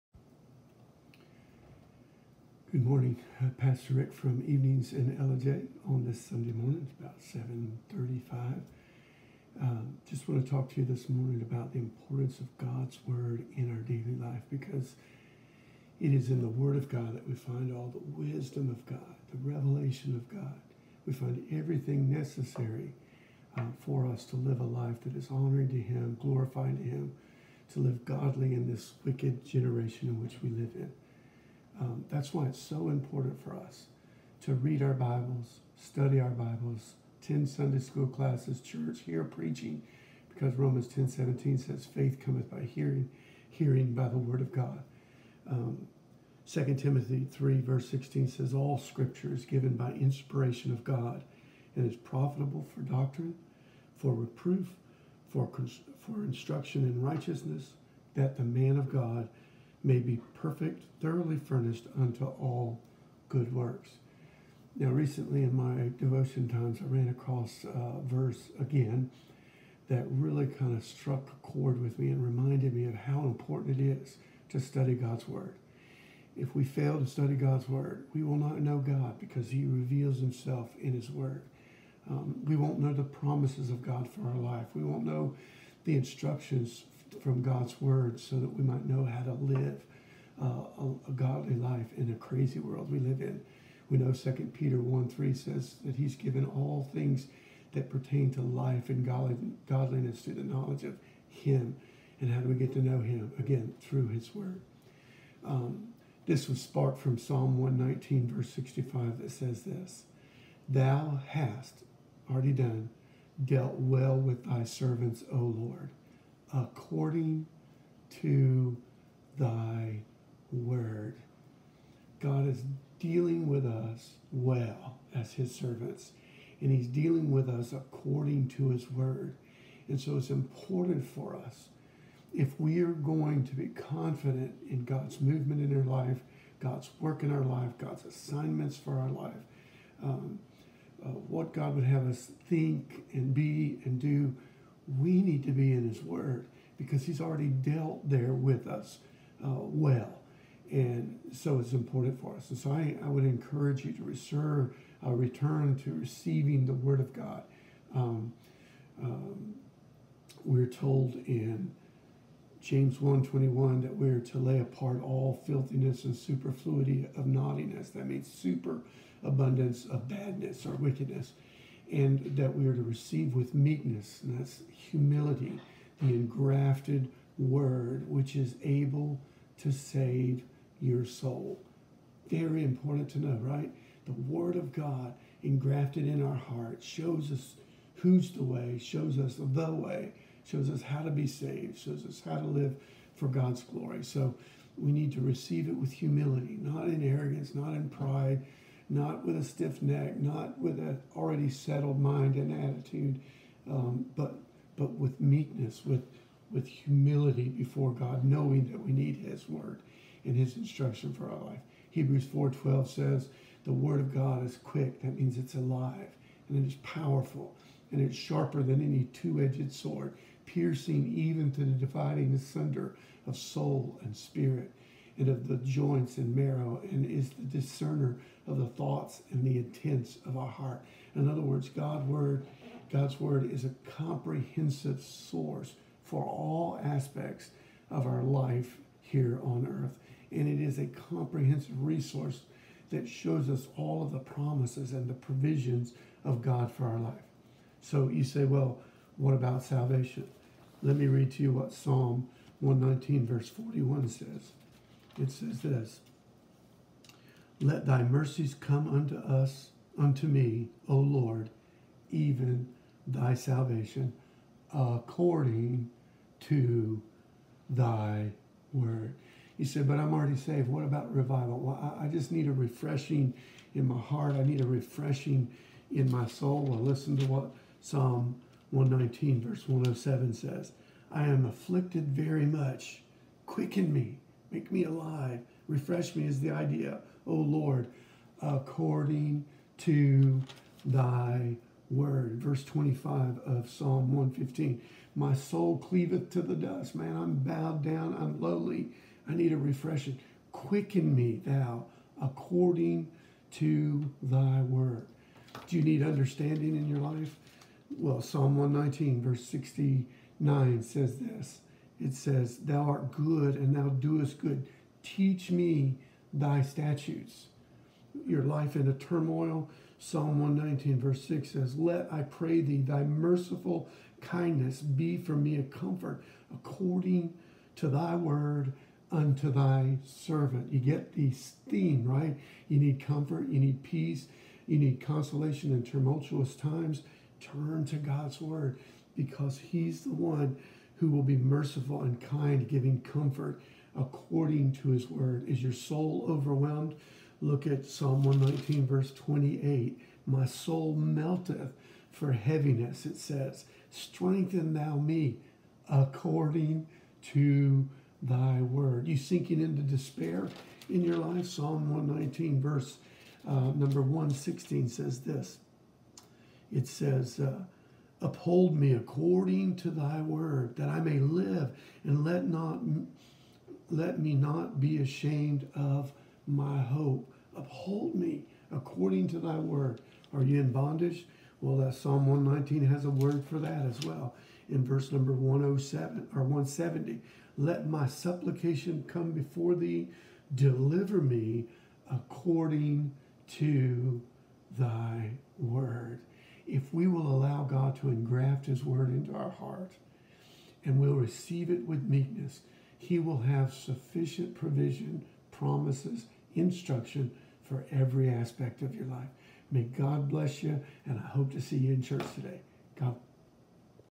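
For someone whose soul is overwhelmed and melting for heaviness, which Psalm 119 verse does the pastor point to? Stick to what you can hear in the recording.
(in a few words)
Verse 28.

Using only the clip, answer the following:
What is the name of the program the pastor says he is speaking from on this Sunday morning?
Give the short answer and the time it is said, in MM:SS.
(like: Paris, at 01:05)
Evenings in Ellijay, at 00:04.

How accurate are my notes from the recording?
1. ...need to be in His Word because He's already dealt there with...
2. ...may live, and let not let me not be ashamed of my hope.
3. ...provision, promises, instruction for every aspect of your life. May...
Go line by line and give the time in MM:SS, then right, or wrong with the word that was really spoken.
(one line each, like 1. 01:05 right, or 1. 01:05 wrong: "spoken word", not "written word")
1. 02:25 right
2. 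06:10 right
3. 06:44 right.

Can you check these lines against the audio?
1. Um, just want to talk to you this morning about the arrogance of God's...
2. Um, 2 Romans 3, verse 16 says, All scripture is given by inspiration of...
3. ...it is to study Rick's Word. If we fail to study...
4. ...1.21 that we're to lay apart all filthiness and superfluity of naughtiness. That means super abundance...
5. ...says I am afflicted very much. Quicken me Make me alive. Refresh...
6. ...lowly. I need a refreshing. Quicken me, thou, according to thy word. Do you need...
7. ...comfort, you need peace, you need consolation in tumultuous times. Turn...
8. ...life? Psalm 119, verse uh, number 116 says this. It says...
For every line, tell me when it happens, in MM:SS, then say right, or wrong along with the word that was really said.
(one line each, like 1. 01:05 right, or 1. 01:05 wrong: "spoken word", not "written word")
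1. 00:09 wrong: "importance", not "arrogance"
2. 00:45 wrong: "Timothy", not "Romans"
3. 01:13 wrong: "God", not "Rick"
4. 02:42 right
5. 04:40 right
6. 04:58 right
7. 05:33 right
8. 06:01 right.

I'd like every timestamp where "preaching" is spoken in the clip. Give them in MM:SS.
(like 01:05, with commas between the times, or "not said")
00:39.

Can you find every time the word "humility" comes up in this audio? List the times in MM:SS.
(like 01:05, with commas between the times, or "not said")
02:54, 03:15, 03:26.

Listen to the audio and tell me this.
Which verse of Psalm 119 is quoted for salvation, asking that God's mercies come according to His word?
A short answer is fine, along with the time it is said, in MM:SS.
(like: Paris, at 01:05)
Verse 41, at 04:13.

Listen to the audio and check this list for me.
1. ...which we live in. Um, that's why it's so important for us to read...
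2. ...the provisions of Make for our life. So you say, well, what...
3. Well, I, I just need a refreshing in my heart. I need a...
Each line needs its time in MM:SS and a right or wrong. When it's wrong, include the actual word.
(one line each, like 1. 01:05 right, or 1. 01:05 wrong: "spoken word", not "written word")
1. 00:30 right
2. 04:05 wrong: "God", not "Make"
3. 04:31 right.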